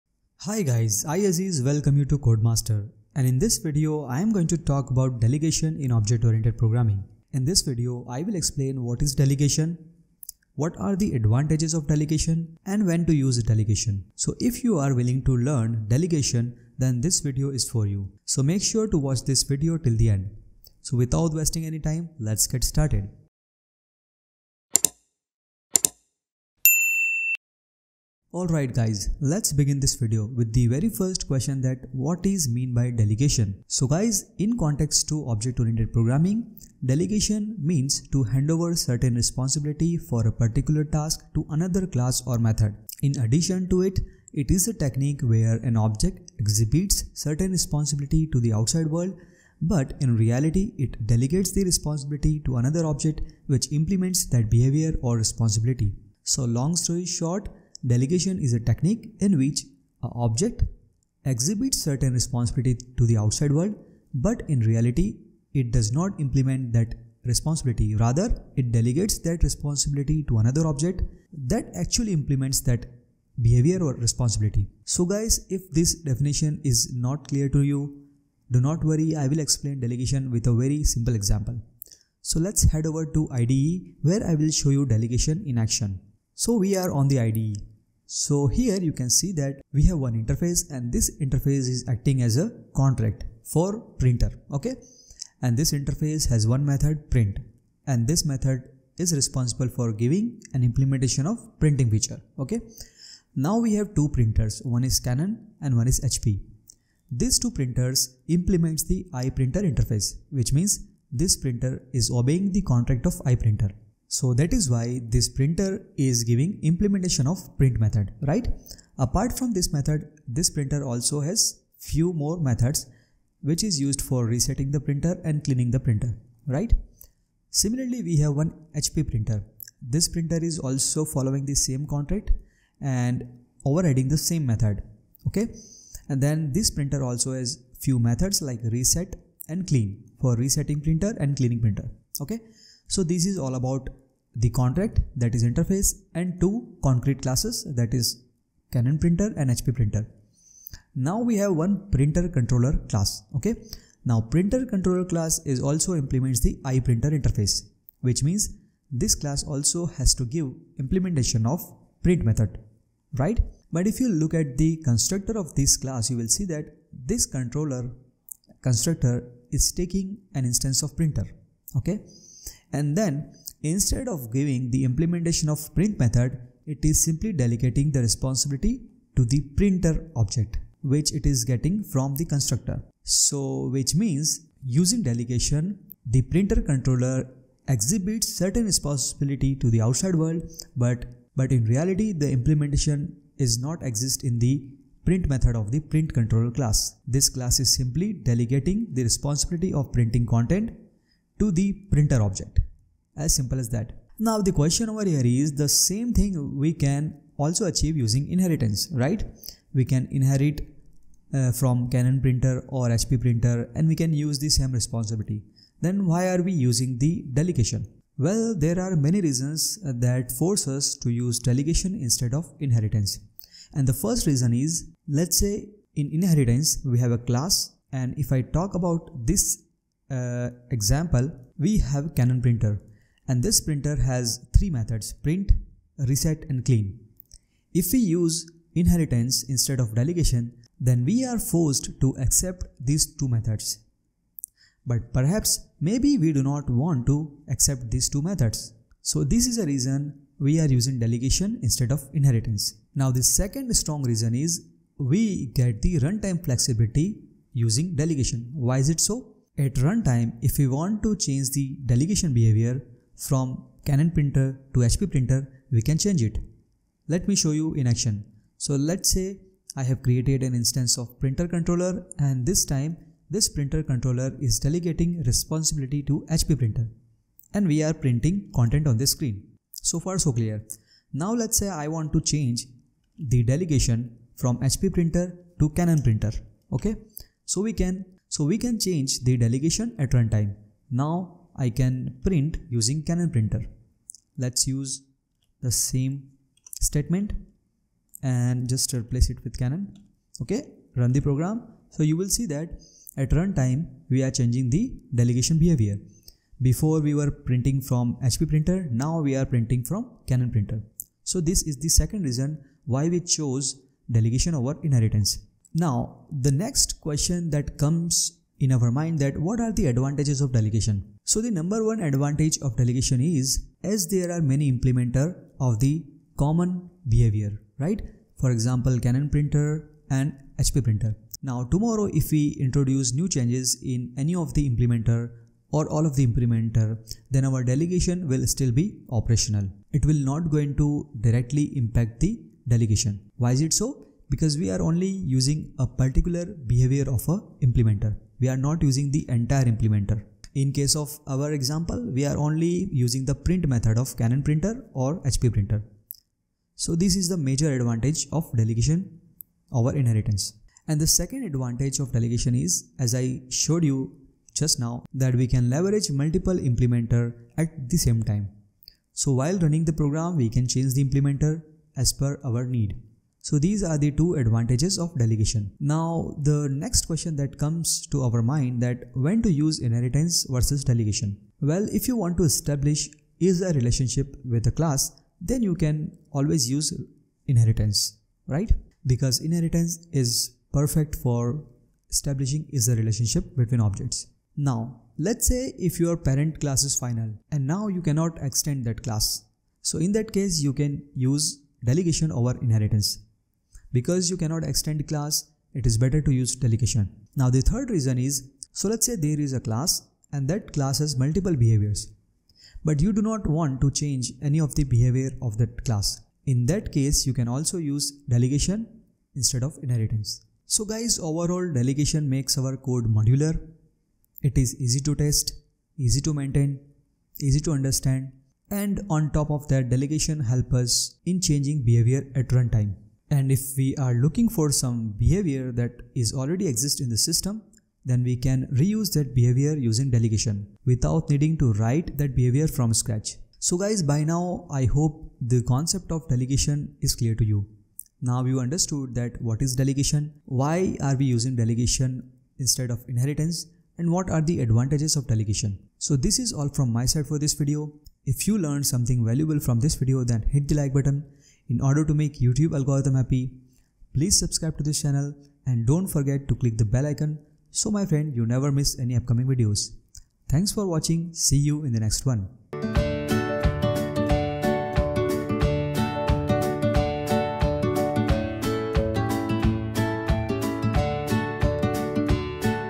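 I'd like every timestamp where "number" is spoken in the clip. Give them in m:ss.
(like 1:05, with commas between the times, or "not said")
5:21.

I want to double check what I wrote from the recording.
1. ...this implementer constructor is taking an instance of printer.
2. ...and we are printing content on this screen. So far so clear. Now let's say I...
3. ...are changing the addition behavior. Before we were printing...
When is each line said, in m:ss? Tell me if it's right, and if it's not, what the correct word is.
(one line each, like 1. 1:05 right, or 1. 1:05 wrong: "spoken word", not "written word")
1. 2:46 wrong: "controller", not "implementer"
2. 4:37 right
3. 5:04 wrong: "delegation", not "addition".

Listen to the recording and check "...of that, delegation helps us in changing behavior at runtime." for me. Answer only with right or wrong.
right.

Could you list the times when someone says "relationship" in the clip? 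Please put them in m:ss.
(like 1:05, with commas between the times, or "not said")
6:23, 6:32.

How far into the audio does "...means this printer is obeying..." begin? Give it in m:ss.
1:50.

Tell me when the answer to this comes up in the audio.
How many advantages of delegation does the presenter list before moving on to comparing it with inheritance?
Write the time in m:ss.
6:14.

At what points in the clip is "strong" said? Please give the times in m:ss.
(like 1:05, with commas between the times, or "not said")
4:13.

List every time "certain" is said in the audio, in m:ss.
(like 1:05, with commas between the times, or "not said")
0:38, 0:47, 1:01, 3:08.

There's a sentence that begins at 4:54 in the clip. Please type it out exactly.
Let's use the same statement and just replace it with Canon.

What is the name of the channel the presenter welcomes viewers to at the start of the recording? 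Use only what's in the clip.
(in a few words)
CoedMaster.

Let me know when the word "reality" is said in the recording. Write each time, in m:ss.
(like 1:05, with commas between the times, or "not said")
0:50, 1:04, 3:11.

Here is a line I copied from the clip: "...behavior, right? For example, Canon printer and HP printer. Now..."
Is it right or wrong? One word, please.
right.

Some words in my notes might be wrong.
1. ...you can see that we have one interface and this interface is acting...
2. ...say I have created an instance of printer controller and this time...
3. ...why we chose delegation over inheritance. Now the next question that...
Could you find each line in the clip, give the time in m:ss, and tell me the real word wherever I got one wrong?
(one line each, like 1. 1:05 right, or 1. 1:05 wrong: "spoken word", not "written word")
1. 1:28 right
2. 4:29 right
3. 5:12 right.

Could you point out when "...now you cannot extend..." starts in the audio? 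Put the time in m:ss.
6:37.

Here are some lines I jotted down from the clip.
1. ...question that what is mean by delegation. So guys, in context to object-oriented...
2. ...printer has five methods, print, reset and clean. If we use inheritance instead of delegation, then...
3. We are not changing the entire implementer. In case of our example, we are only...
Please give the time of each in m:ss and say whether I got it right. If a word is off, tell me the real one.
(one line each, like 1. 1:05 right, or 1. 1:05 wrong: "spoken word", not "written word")
1. 0:31 right
2. 3:53 wrong: "three", not "five"
3. 5:48 wrong: "using", not "changing".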